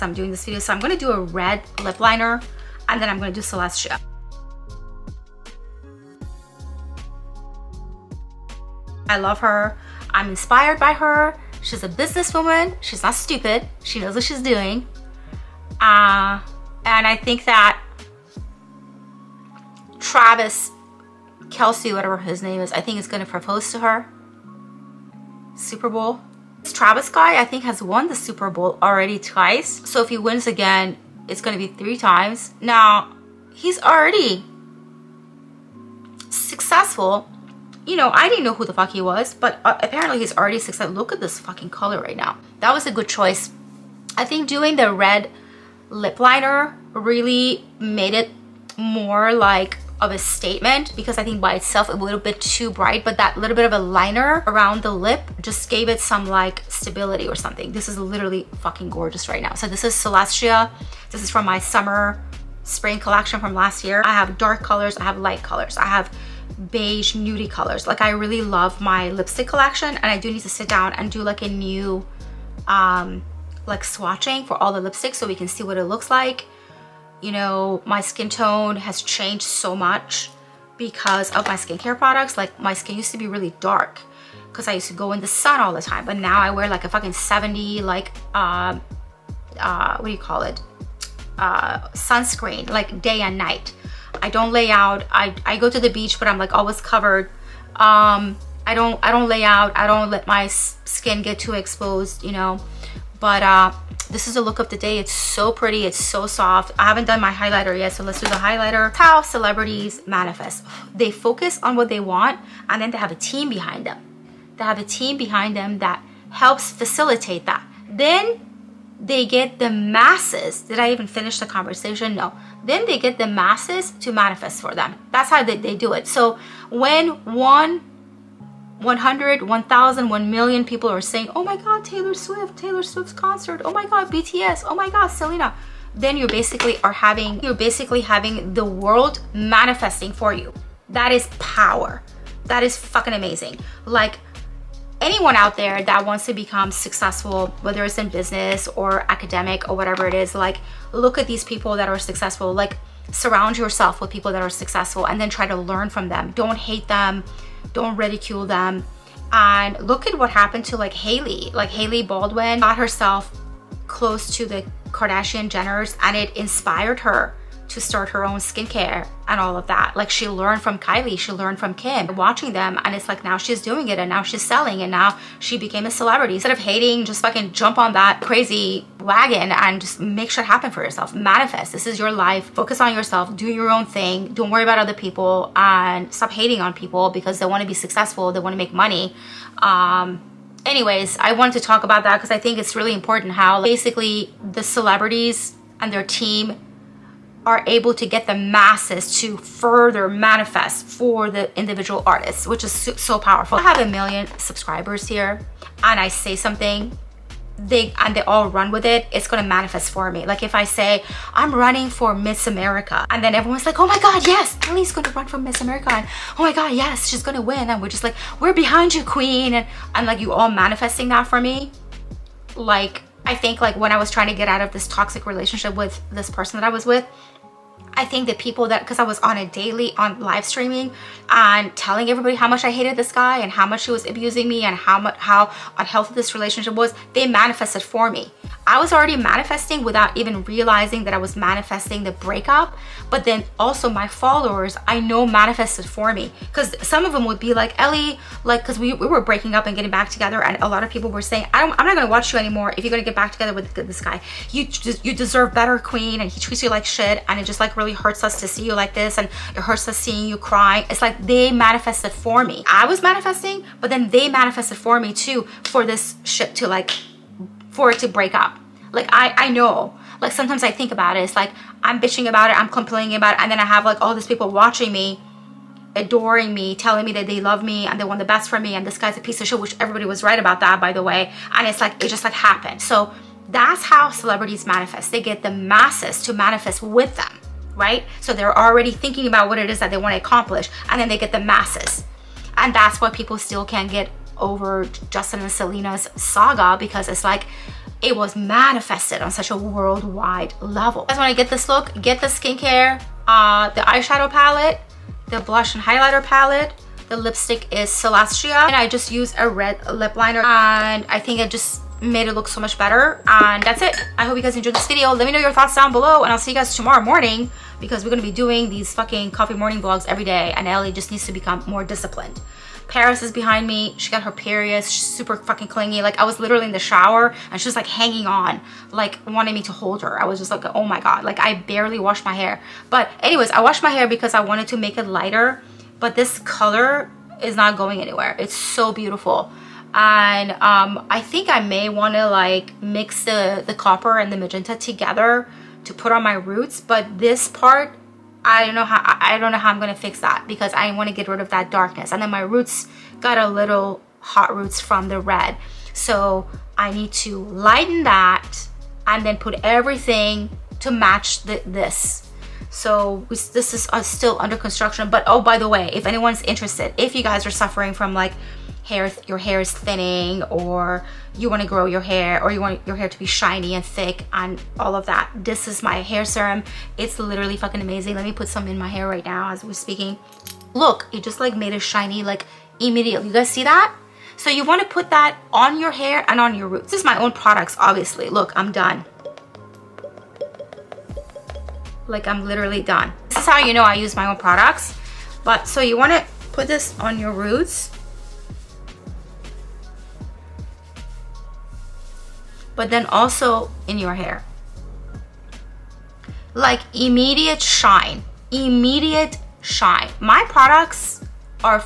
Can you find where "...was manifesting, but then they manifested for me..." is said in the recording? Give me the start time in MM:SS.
04:22.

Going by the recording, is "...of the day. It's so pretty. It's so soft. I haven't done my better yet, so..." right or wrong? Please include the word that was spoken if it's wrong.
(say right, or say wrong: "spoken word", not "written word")
wrong: "highlighter", not "better".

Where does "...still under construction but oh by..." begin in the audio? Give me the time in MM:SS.
06:04.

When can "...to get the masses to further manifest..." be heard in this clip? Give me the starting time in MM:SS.
03:17.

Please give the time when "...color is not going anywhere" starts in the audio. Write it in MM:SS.
05:36.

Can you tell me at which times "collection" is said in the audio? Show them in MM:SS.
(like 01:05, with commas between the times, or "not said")
01:02, 01:09.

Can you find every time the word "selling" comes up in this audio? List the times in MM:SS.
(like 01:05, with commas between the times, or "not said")
02:54.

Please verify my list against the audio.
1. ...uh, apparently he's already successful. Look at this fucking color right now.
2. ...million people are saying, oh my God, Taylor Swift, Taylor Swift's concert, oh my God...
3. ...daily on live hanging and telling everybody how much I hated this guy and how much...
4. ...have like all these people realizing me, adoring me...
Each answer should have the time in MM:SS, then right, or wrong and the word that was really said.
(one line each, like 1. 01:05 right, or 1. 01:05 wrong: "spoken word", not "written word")
1. 00:39 right
2. 02:10 right
3. 03:49 wrong: "streaming", not "hanging"
4. 04:33 wrong: "watching", not "realizing".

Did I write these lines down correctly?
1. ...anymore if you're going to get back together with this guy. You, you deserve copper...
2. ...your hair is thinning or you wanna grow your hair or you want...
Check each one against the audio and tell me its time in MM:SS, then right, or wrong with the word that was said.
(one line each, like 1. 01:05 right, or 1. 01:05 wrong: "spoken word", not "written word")
1. 04:12 wrong: "better", not "copper"
2. 06:09 right.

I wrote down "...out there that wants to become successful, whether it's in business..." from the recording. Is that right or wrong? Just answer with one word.
right.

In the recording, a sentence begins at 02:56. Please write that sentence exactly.
Instead of hating, just fucking jump on that crazy wagon and just make shit happen for yourself.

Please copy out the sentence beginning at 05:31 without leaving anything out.
Like I barely washed my hair.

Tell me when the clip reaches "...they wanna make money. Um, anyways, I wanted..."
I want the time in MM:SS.
03:08.